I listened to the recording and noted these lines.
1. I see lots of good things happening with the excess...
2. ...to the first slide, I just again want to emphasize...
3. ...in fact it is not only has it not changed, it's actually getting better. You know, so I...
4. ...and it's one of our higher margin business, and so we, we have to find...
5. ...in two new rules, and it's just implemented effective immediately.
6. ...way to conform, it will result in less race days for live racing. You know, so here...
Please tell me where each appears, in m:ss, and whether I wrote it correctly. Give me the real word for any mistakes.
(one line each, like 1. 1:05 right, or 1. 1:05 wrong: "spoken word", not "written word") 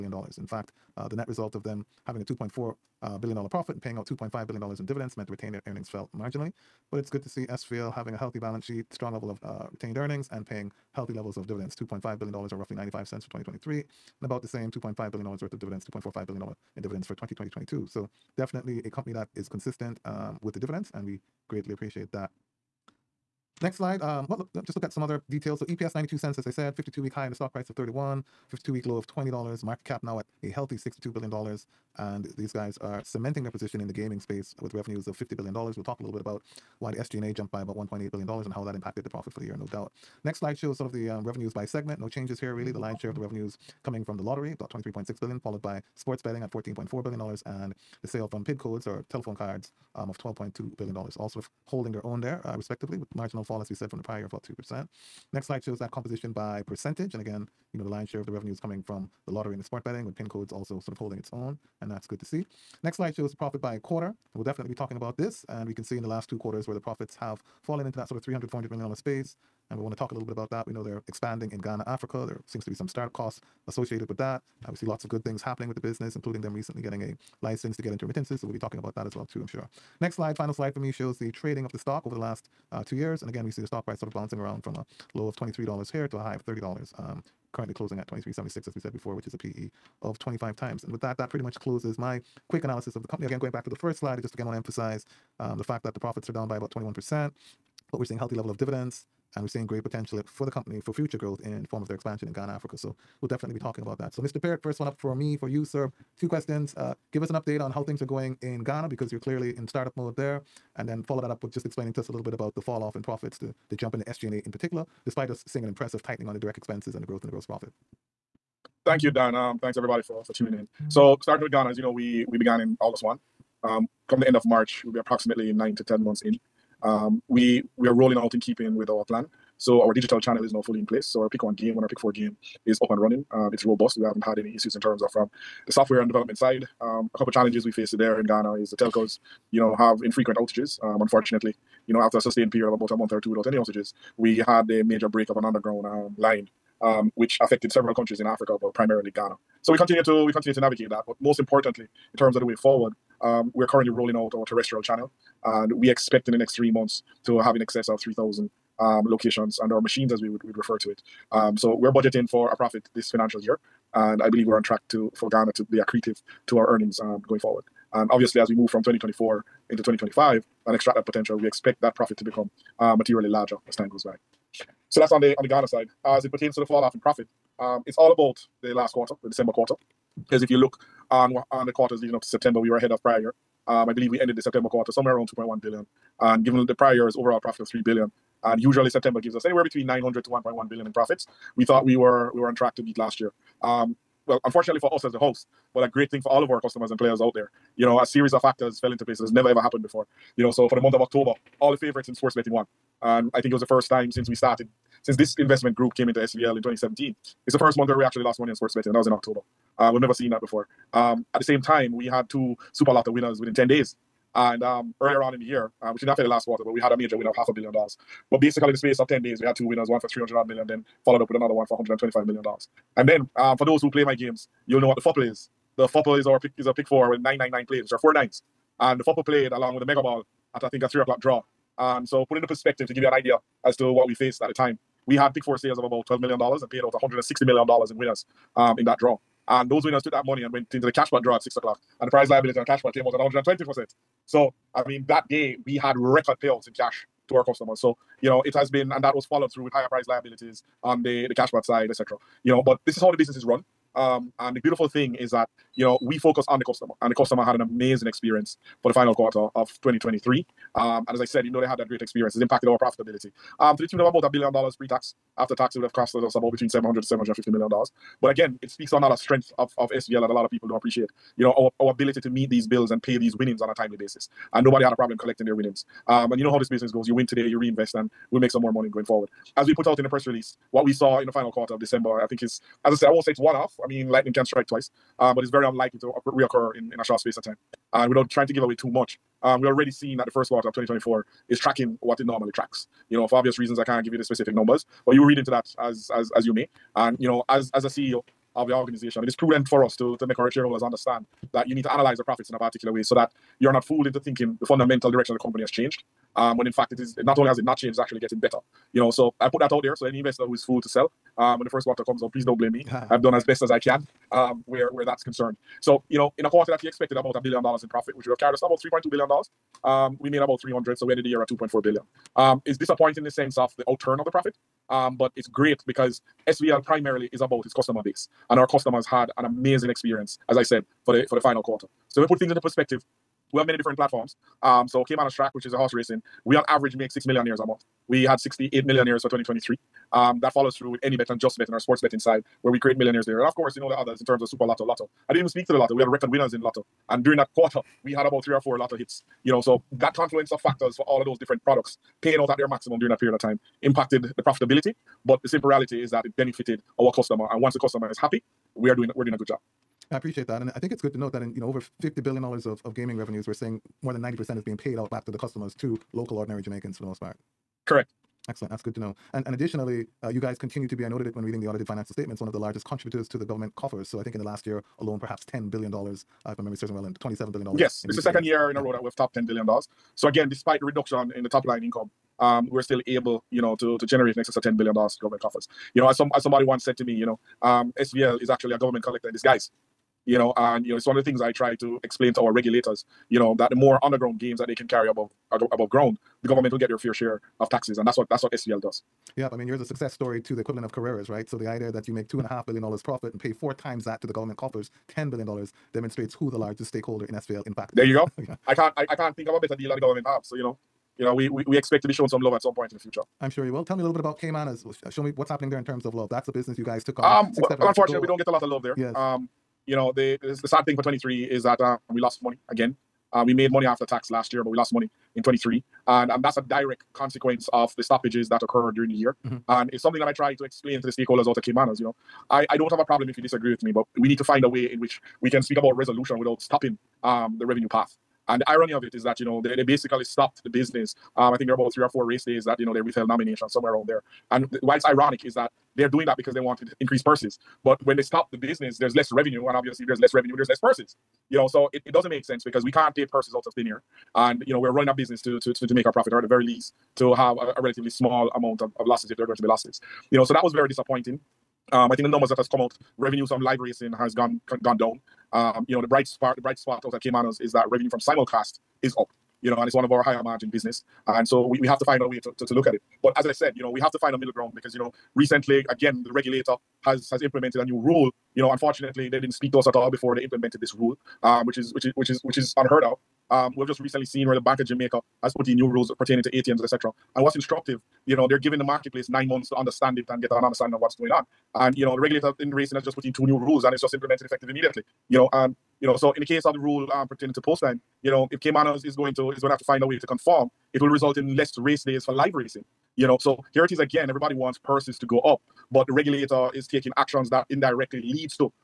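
1. 1:14 wrong: "business", not "excess"
2. 1:33 right
3. 5:06 right
4. 7:49 right
5. 8:13 right
6. 8:20 right.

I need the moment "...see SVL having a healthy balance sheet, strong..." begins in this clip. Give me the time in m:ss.
0:07.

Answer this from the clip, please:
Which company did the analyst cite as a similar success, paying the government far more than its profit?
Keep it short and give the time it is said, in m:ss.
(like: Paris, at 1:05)
Carreras, at 6:40.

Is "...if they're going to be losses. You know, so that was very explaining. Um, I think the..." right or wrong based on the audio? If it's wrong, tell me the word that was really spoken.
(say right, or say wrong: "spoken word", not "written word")
wrong: "disappointing", not "explaining".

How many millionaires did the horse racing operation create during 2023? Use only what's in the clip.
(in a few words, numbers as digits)
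68.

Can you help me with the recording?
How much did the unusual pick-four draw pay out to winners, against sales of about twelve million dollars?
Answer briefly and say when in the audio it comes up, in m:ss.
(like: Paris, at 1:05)
160 million dollars, at 3:56.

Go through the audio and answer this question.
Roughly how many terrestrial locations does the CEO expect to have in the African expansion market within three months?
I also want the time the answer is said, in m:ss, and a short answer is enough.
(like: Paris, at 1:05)
3,000, at 2:37.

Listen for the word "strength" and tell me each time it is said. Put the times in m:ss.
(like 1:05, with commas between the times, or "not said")
4:29.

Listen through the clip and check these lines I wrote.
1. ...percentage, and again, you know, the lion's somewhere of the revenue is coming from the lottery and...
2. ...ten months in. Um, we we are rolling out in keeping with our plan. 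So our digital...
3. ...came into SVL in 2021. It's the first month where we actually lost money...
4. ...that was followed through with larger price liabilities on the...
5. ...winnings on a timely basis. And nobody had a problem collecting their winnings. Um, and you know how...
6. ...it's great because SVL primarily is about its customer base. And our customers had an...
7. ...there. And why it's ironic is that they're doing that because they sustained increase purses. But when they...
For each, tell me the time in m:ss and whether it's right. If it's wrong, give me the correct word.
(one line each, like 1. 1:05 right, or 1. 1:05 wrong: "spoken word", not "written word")
1. 0:56 wrong: "share", not "somewhere"
2. 2:05 right
3. 3:25 wrong: "2017", not "2021"
4. 4:09 wrong: "higher", not "larger"
5. 4:33 right
6. 5:25 right
7. 7:24 wrong: "wanted", not "sustained".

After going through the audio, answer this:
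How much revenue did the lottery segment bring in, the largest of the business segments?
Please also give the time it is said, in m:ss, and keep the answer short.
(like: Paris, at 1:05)
23.6 billion, at 0:44.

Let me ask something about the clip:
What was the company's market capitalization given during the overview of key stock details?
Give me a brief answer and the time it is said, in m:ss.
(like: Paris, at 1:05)
$62 billion, at 0:30.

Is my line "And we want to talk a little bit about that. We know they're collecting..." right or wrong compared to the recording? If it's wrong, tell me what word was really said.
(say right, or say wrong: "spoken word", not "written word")
wrong: "expanding", not "collecting".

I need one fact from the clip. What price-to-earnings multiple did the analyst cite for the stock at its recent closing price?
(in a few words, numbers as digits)
25.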